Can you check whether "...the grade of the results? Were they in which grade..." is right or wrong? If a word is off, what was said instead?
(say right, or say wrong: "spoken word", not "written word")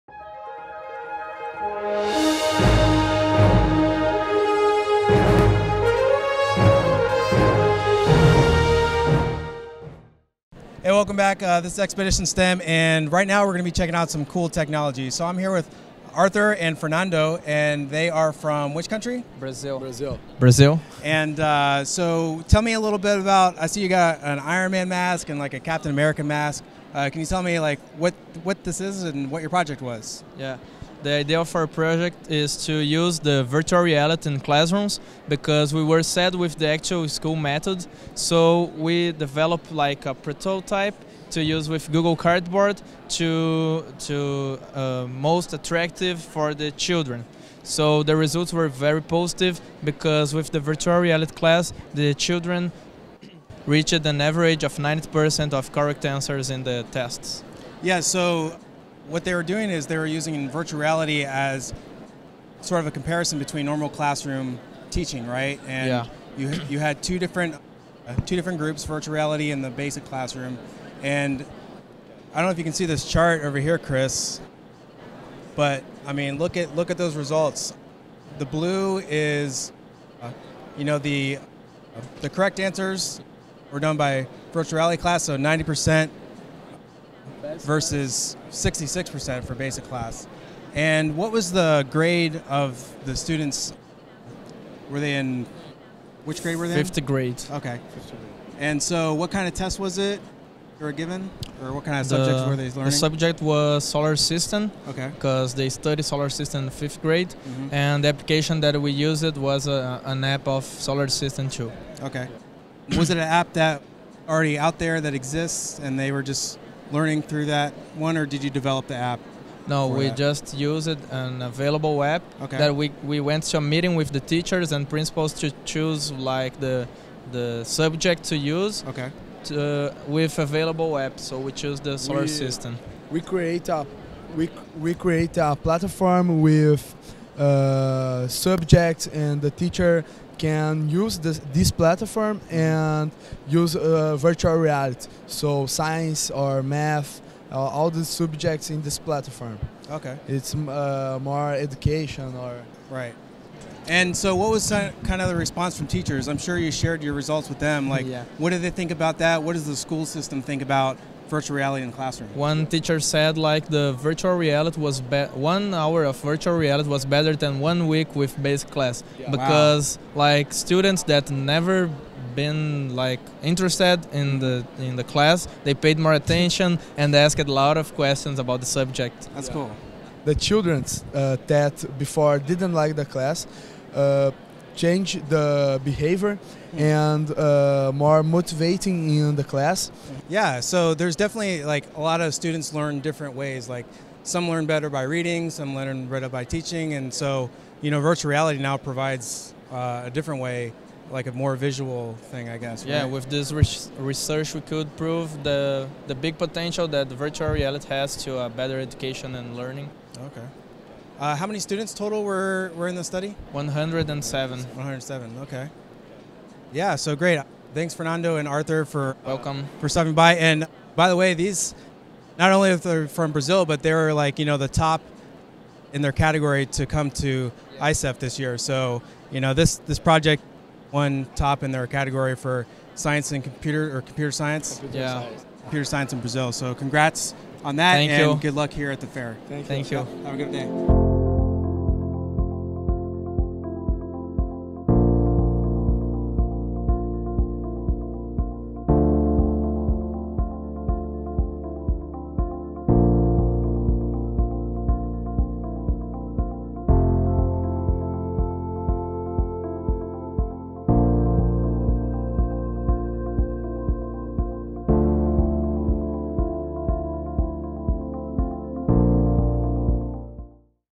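wrong: "students", not "results".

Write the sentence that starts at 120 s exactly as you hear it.
just used an available app okay.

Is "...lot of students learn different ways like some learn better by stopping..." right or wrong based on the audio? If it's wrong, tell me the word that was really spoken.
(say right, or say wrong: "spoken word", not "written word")
wrong: "reading", not "stopping".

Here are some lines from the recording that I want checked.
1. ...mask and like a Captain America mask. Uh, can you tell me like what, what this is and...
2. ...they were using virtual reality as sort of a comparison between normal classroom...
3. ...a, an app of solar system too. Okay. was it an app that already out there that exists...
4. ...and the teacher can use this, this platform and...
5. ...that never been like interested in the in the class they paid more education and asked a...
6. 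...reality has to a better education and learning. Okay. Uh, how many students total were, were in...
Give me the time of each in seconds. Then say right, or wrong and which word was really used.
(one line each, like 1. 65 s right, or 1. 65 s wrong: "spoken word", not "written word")
1. 24 s right
2. 59 s right
3. 109 s right
4. 139 s right
5. 171 s wrong: "attention", not "education"
6. 207 s right.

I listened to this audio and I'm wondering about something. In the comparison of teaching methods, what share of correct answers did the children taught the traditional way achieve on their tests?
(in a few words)
66%.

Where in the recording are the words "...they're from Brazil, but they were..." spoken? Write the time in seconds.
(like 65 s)
222 s.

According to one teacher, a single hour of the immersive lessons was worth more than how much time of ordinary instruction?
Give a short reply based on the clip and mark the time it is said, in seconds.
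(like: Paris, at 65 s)
One week, at 167 s.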